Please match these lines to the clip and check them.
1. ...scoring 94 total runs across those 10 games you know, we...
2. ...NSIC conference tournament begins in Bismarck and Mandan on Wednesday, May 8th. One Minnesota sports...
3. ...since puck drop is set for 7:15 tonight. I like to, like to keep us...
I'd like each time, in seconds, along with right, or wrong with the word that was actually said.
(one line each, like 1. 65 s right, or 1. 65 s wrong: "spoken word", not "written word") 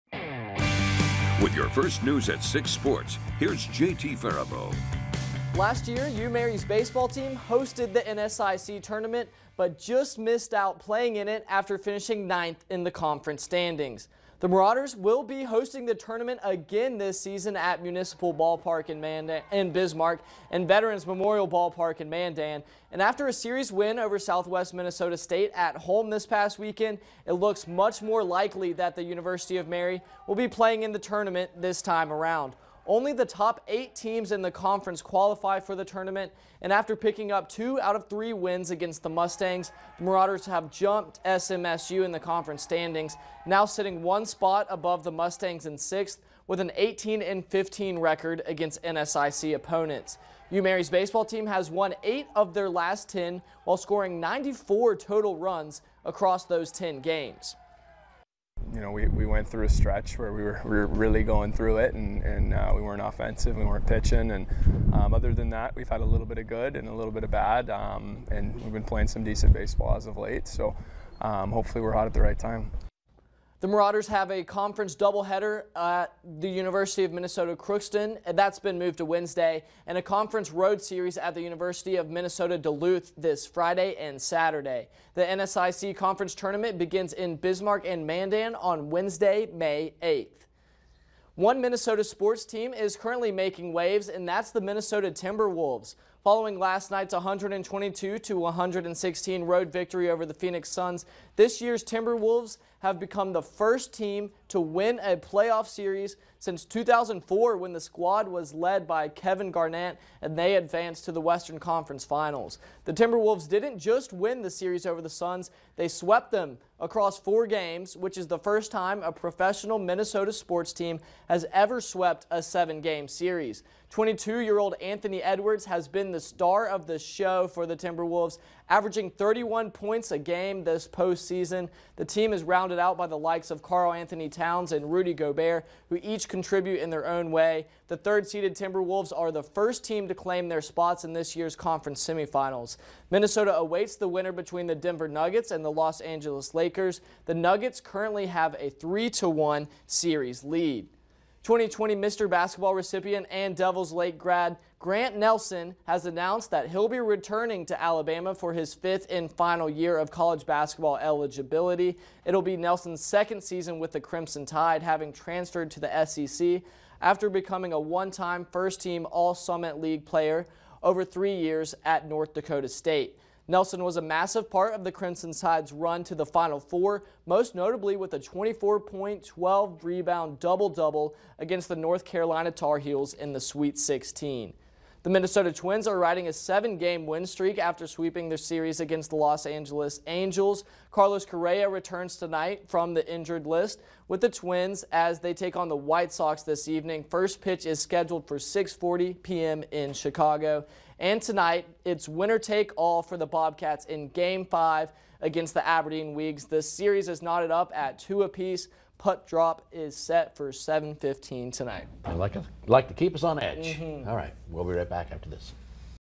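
1. 53 s right
2. 85 s right
3. 208 s wrong: "apiece", not "since".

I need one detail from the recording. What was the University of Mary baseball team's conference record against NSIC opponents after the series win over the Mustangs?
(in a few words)
18-15.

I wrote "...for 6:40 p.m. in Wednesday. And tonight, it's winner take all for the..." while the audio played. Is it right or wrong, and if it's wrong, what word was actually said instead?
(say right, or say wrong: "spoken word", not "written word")
wrong: "Chicago", not "Wednesday".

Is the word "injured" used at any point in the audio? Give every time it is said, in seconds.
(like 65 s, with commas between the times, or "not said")
193 s.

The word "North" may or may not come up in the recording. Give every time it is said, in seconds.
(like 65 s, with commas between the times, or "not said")
172 s, 181 s.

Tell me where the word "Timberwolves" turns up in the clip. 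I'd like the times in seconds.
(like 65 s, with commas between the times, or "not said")
95 s, 101 s, 112 s, 127 s, 138 s.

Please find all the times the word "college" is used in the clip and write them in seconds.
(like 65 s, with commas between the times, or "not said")
160 s.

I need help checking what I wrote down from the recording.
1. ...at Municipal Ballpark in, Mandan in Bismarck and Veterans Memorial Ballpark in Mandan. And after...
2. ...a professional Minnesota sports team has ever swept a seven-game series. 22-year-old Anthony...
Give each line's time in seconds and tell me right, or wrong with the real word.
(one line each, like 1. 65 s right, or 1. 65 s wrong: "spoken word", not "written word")
1. 17 s right
2. 119 s right.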